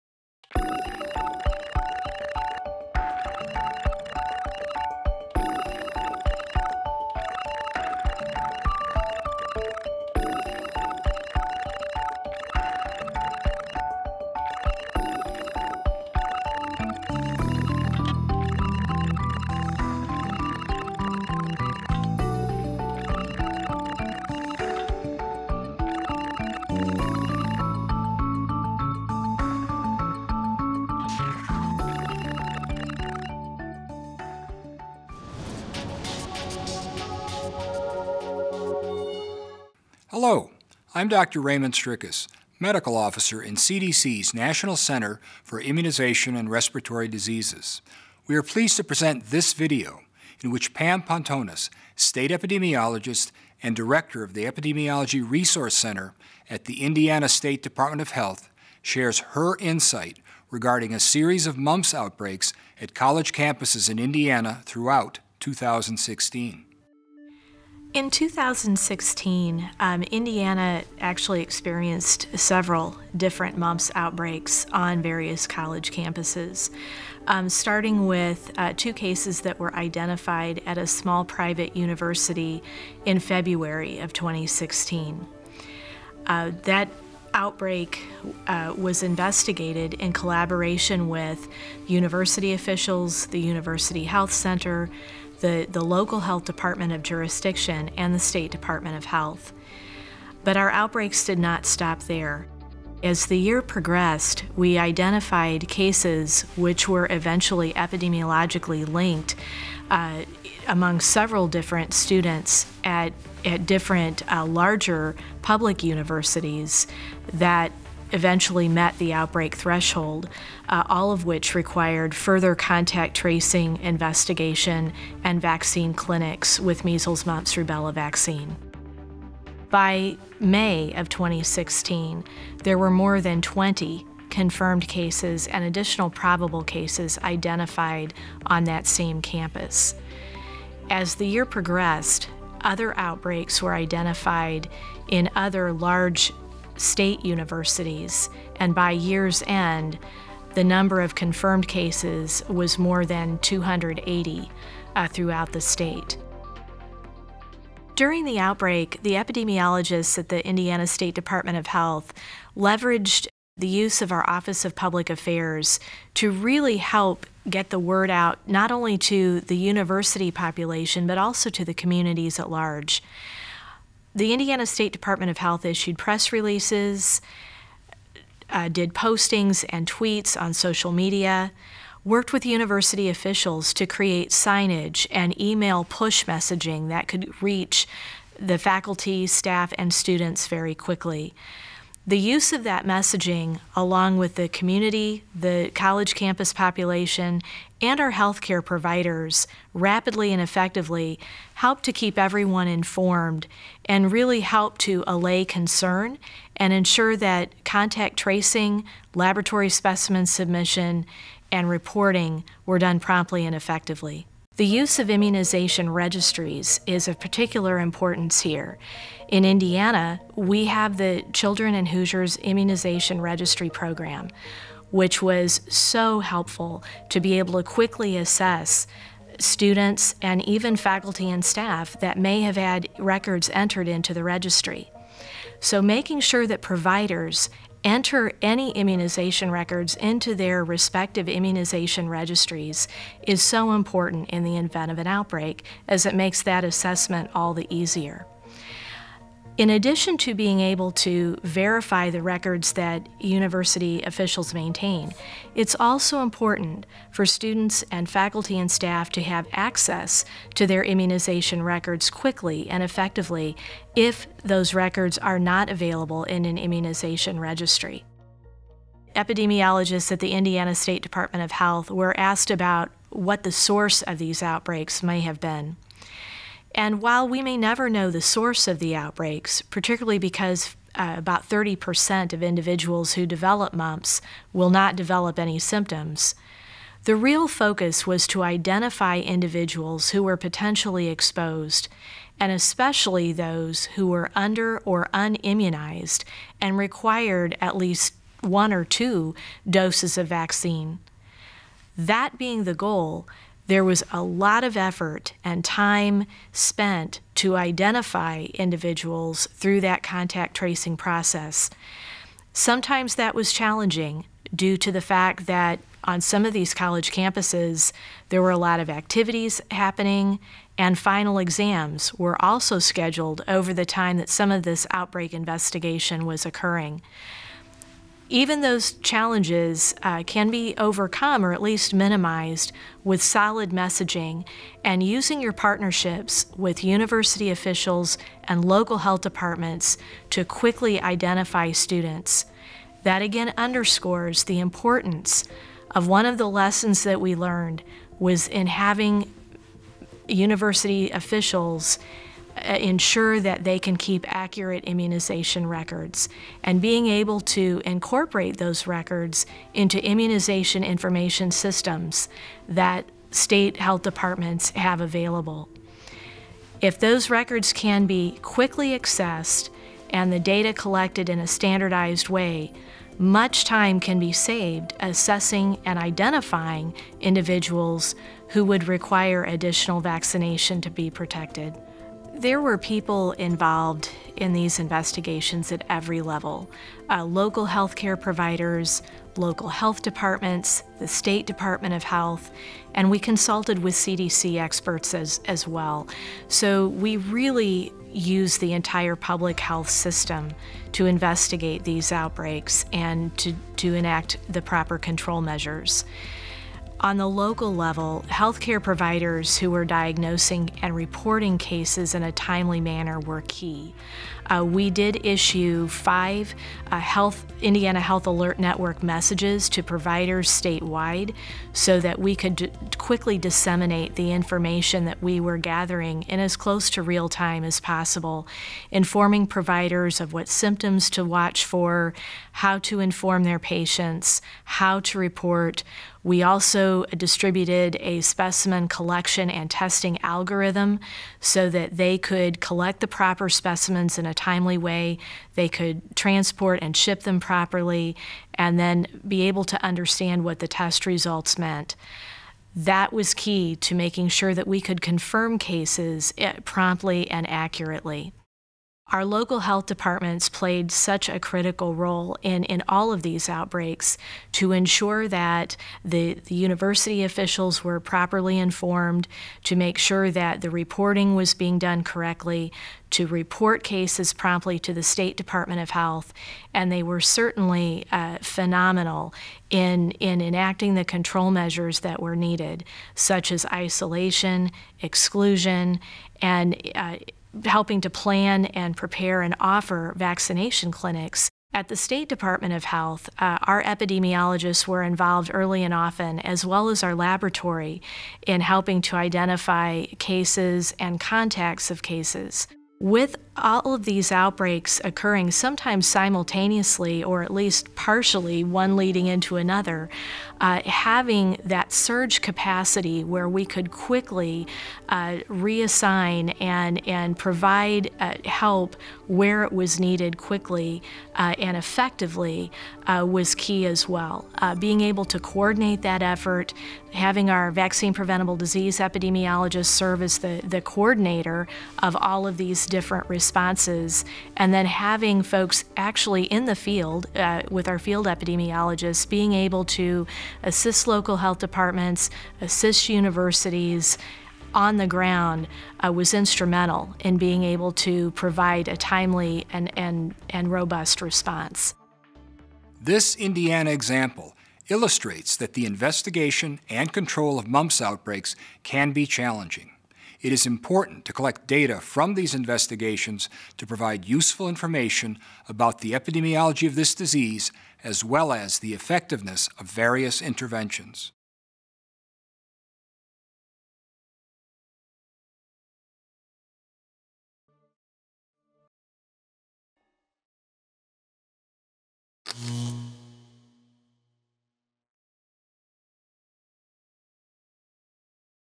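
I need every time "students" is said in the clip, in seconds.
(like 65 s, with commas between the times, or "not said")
111 s, 189 s, 229 s, 257 s, 341 s.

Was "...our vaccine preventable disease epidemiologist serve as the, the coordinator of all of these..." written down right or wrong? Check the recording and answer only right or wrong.
right.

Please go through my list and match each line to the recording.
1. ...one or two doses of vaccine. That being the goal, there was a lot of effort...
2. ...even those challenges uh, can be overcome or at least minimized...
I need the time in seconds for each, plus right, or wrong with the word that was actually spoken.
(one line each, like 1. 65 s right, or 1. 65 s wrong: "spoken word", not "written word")
1. 298 s right
2. 328 s right.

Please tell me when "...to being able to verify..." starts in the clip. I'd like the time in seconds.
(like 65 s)
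250 s.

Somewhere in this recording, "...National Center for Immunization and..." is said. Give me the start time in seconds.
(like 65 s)
44 s.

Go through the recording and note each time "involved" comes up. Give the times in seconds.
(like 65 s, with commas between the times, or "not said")
383 s, 495 s.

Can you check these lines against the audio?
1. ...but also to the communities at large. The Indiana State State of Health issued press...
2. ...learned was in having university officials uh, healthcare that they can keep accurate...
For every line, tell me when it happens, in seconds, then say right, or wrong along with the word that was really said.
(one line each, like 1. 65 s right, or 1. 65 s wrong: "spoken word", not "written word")
1. 171 s wrong: "Department", not "State"
2. 347 s wrong: "ensure", not "healthcare".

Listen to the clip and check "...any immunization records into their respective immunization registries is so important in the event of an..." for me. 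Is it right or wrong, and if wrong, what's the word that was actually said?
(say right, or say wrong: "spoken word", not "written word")
right.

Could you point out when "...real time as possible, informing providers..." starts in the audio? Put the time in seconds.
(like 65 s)
427 s.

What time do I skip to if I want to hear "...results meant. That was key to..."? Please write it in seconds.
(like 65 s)
451 s.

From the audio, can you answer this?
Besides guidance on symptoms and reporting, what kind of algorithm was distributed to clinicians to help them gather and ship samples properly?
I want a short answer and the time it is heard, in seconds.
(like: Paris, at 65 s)
specimen collection and testing algorithm, at 438 s.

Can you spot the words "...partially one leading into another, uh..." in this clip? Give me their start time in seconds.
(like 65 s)
507 s.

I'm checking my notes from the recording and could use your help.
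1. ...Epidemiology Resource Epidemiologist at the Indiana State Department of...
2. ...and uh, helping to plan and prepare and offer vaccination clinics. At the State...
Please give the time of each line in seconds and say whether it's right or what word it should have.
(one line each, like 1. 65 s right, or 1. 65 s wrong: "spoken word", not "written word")
1. 54 s wrong: "Center", not "Epidemiologist"
2. 486 s right.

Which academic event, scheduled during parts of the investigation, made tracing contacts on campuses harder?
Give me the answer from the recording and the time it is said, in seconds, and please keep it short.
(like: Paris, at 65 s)
final exams, at 320 s.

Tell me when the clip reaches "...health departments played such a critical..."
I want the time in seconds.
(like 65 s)
459 s.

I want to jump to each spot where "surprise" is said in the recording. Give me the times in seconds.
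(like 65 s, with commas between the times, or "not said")
not said.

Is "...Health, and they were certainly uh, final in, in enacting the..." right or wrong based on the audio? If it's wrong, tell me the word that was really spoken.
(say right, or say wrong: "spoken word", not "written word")
wrong: "phenomenal", not "final".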